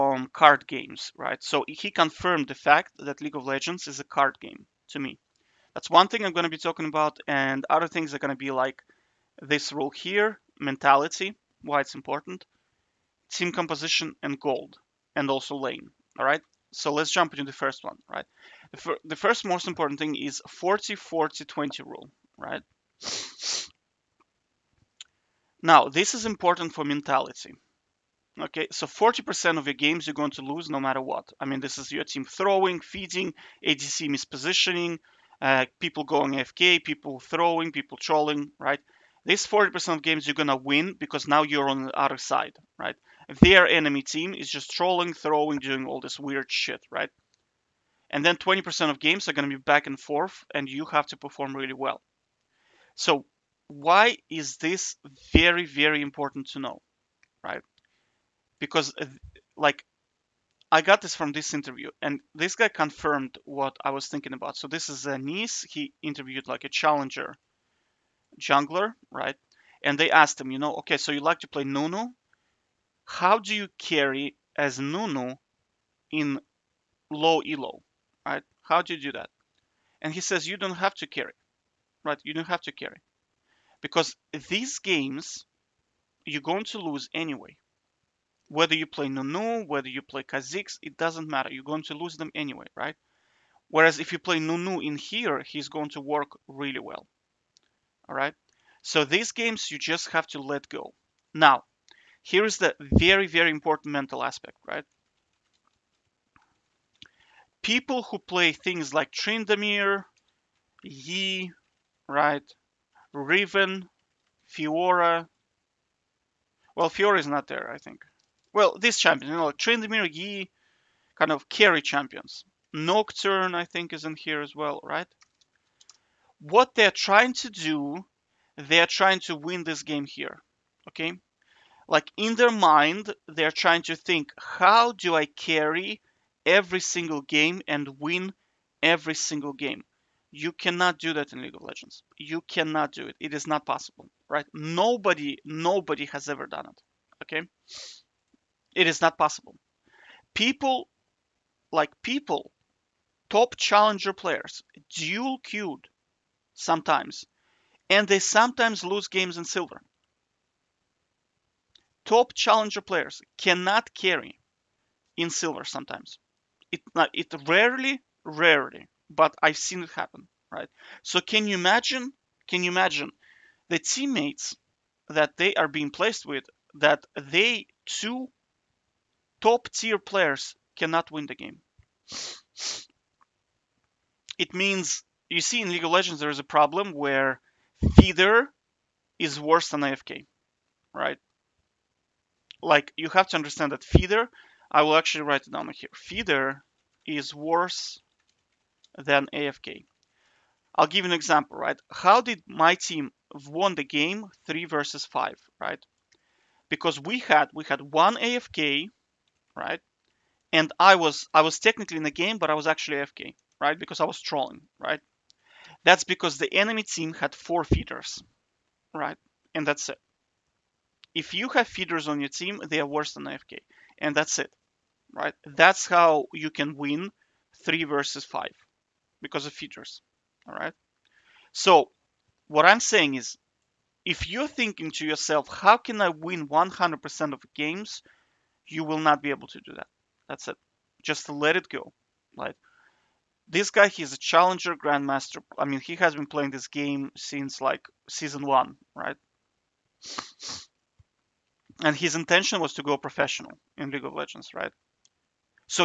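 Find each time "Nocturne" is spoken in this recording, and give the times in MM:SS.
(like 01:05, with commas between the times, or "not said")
02:02.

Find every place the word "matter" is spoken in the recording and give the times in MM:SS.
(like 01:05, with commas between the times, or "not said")
00:30, 01:31.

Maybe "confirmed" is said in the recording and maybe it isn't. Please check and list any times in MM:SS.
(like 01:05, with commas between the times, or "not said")
00:01, 01:02.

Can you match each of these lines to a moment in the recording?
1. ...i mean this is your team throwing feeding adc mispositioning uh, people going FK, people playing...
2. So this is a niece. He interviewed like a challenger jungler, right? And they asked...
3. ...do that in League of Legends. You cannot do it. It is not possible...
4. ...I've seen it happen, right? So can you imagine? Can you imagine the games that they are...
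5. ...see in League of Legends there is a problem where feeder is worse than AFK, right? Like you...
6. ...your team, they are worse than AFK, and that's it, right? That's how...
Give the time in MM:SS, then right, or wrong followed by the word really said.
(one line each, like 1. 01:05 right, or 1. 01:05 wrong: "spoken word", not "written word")
1. 00:31 wrong: "throwing", not "playing"
2. 01:04 right
3. 02:20 right
4. 02:49 wrong: "teammates", not "games"
5. 03:05 right
6. 03:42 right.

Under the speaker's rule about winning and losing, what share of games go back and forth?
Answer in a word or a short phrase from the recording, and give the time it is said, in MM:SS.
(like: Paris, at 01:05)
20%, at 00:48.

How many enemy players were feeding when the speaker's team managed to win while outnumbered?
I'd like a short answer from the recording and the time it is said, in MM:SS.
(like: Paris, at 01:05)
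4, at 03:37.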